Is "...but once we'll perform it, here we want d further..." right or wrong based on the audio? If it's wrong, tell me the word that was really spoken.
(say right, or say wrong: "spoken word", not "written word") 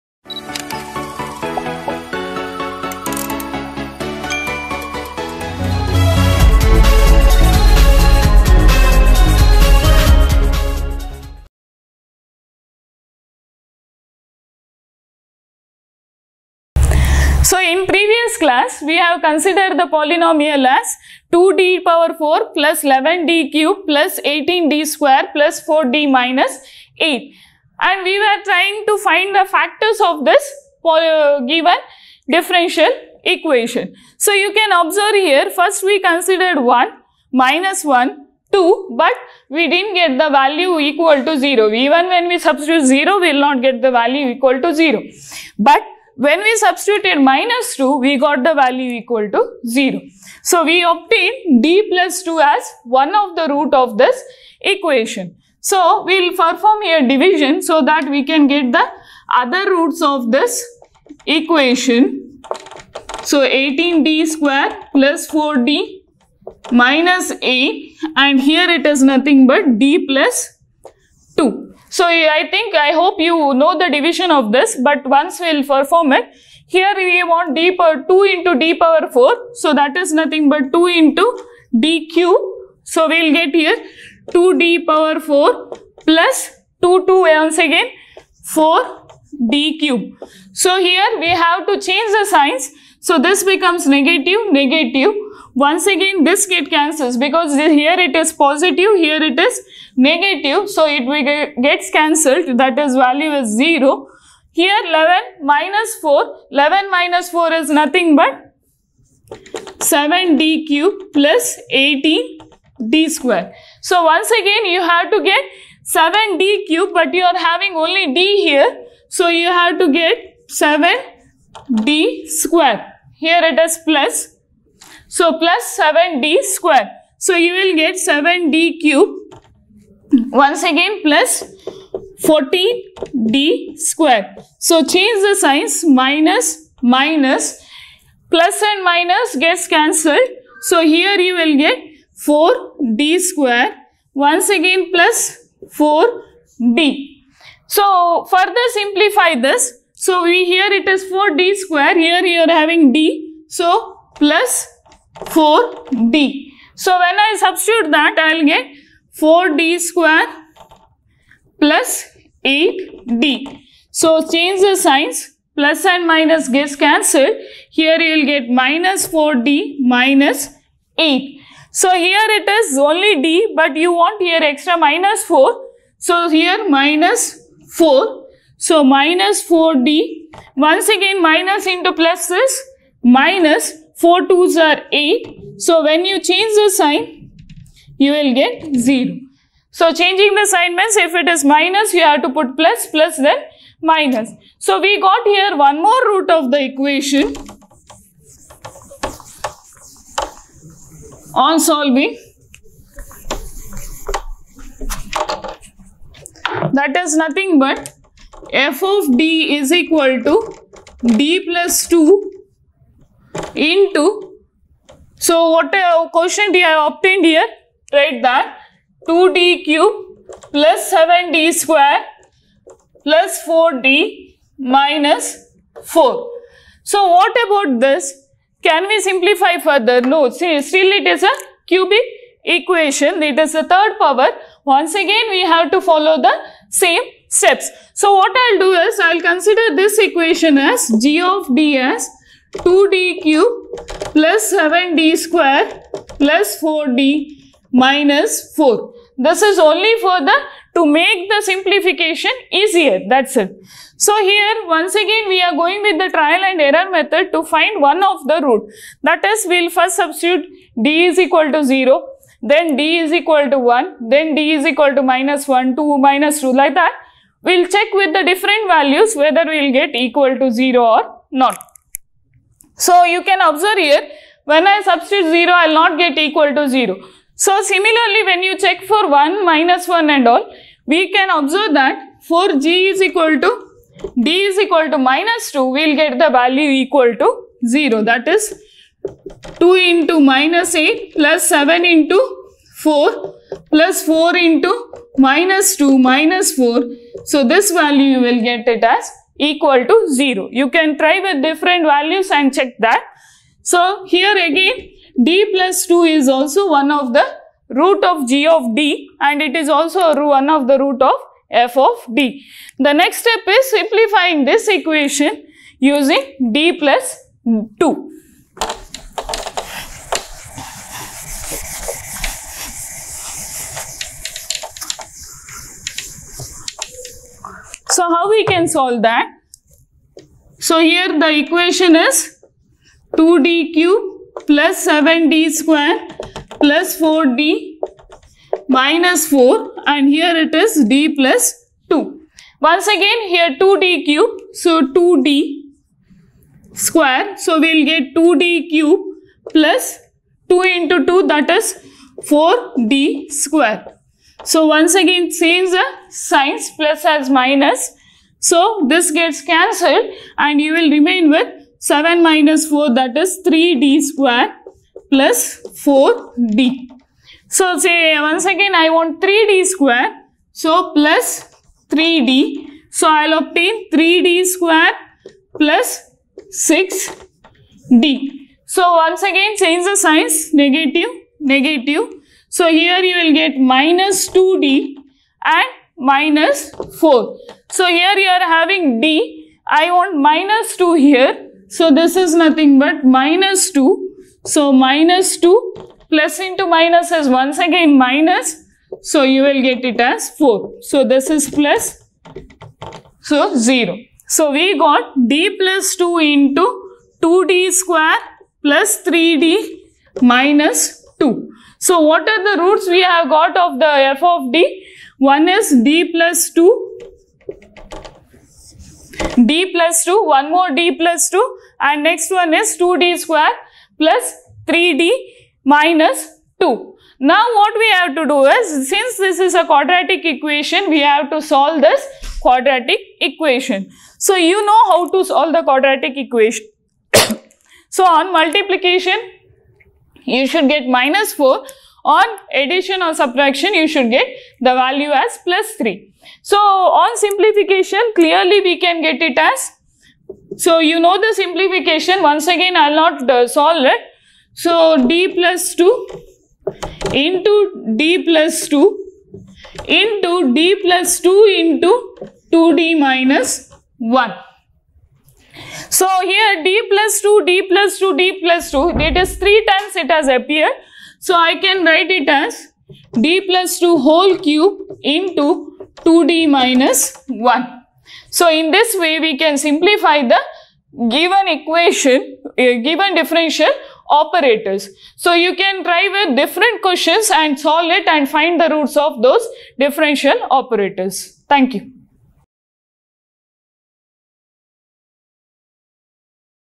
wrong: "power", not "further".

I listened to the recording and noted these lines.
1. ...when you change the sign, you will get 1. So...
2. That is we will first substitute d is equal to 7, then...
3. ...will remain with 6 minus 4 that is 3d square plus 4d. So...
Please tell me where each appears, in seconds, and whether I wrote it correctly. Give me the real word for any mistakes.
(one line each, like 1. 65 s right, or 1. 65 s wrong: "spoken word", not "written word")
1. 185 s wrong: "0", not "1"
2. 259 s wrong: "0", not "7"
3. 360 s wrong: "7", not "6".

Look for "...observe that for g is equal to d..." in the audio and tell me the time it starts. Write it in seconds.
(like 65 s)
281 s.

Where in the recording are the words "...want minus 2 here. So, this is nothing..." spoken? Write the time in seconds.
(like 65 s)
389 s.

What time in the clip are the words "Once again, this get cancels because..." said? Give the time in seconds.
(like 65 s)
95 s.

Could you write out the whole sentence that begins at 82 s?
So we'll get here 2d power 4 plus 2 2 once again 4 d cube.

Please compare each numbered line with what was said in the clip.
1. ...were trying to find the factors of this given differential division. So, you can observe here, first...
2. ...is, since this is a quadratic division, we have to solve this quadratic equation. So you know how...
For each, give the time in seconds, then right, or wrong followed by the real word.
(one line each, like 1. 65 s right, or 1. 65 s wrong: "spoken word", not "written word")
1. 28 s wrong: "equation", not "division"
2. 428 s wrong: "equation", not "division".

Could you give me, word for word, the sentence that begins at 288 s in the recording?
That is 2 into minus 8 plus 7 into 4 plus 4 into minus 2 minus 4.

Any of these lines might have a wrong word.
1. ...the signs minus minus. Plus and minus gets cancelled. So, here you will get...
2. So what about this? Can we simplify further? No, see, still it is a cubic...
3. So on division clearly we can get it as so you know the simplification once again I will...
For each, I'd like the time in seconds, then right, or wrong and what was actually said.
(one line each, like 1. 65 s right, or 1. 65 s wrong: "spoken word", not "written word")
1. 135 s right
2. 226 s right
3. 446 s wrong: "simplification", not "division".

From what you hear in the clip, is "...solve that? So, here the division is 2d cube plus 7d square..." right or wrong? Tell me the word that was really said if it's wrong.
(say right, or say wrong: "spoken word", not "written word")
wrong: "equation", not "division".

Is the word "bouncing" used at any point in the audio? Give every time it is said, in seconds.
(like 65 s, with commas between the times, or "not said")
not said.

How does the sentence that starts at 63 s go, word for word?
So 18d square plus 4d minus a and here it is nothing but d plus 2.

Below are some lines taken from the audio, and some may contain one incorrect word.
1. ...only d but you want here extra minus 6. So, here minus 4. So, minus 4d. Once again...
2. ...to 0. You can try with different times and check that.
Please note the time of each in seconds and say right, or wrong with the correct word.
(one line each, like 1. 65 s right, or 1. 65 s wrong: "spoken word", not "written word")
1. 172 s wrong: "4", not "6"
2. 299 s wrong: "values", not "times".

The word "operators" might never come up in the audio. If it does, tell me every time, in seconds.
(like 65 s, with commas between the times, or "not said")
484 s, 490 s.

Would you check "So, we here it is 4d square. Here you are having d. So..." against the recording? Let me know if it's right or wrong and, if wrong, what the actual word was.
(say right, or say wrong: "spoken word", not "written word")
right.